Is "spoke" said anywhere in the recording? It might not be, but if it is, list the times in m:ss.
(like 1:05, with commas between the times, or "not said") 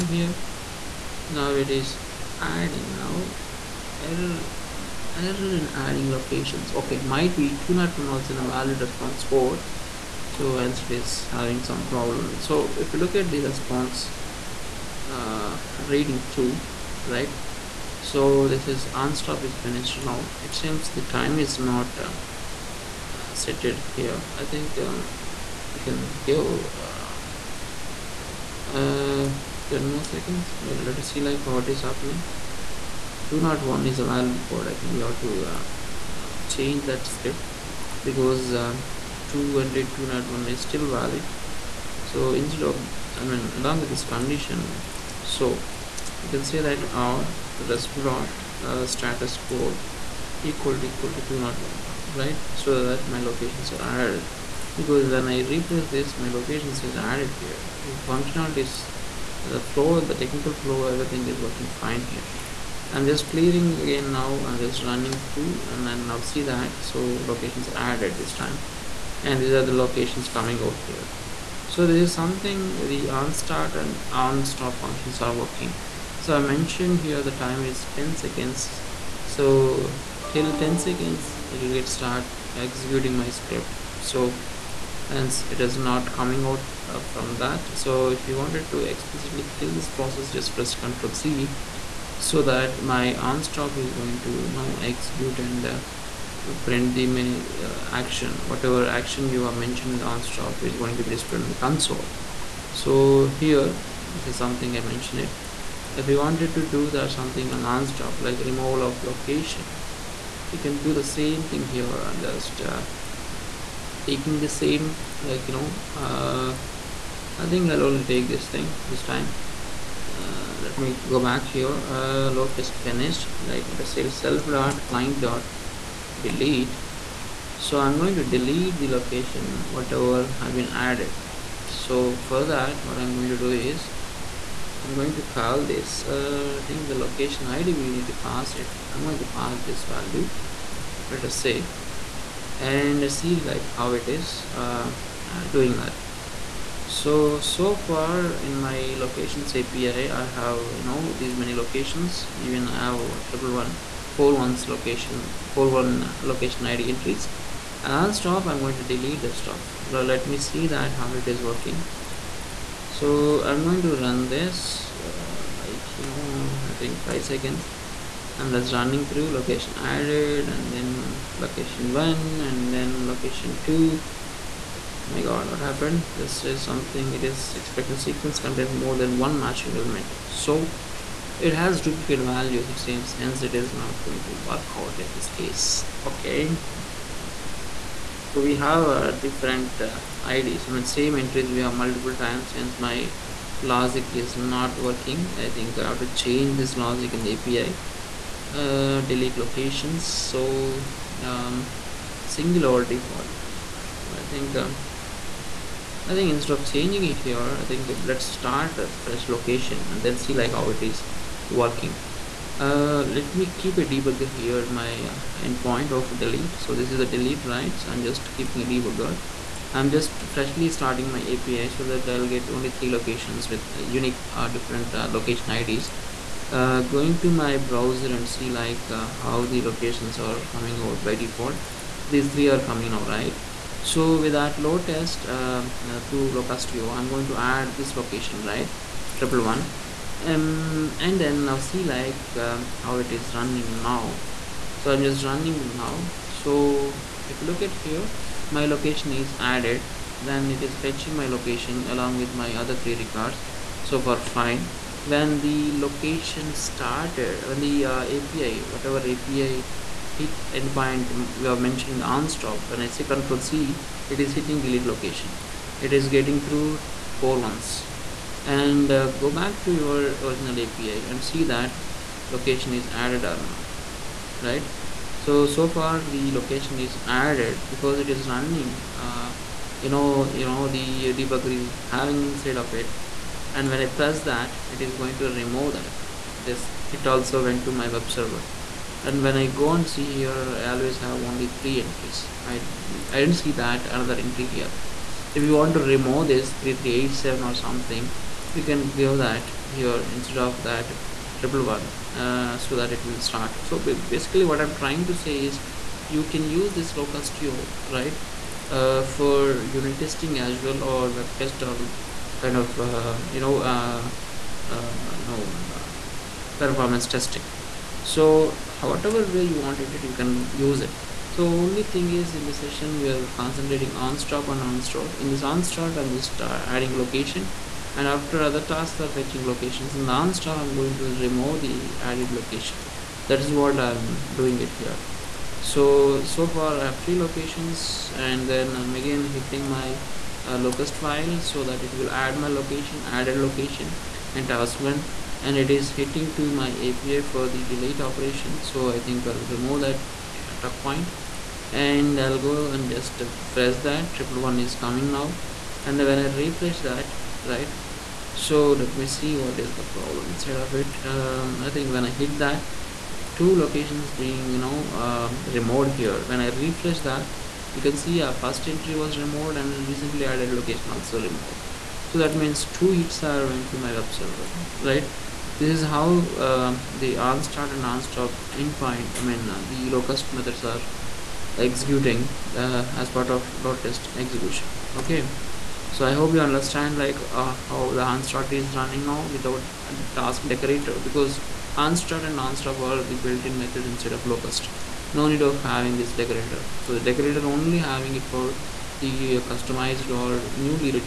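not said.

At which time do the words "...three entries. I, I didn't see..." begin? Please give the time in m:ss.
4:51.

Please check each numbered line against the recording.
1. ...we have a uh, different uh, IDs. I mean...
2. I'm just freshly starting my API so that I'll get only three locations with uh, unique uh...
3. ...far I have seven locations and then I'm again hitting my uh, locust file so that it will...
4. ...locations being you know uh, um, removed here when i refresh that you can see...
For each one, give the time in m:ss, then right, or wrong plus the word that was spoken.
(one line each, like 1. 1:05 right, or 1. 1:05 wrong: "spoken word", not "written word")
1. 3:08 right
2. 3:39 right
3. 5:36 wrong: "three", not "seven"
4. 6:03 right.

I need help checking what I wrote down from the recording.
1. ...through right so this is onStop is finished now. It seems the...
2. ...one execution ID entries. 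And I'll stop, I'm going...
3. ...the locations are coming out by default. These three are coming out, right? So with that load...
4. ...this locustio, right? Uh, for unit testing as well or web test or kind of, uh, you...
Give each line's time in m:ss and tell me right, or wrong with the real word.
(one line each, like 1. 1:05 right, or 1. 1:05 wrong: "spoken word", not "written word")
1. 0:16 right
2. 2:35 wrong: "location", not "execution"
3. 3:49 right
4. 5:06 right.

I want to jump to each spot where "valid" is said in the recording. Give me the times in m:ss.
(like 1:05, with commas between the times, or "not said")
0:08, 0:34, 0:40.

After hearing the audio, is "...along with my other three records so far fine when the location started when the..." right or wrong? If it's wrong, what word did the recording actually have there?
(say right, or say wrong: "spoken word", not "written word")
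right.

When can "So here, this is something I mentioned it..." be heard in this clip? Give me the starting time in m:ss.
1:42.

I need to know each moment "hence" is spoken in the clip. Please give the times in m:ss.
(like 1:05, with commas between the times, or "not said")
0:10, 1:25, 3:03.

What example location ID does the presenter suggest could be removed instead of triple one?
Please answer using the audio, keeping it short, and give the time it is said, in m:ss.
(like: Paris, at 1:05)
3387, at 4:56.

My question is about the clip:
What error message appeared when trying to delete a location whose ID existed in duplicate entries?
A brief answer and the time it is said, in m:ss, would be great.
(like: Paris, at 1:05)
sequence contains more than one matching element, at 2:57.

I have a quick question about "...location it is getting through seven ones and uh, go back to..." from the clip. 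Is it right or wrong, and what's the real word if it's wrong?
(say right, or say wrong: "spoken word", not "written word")
wrong: "four", not "seven".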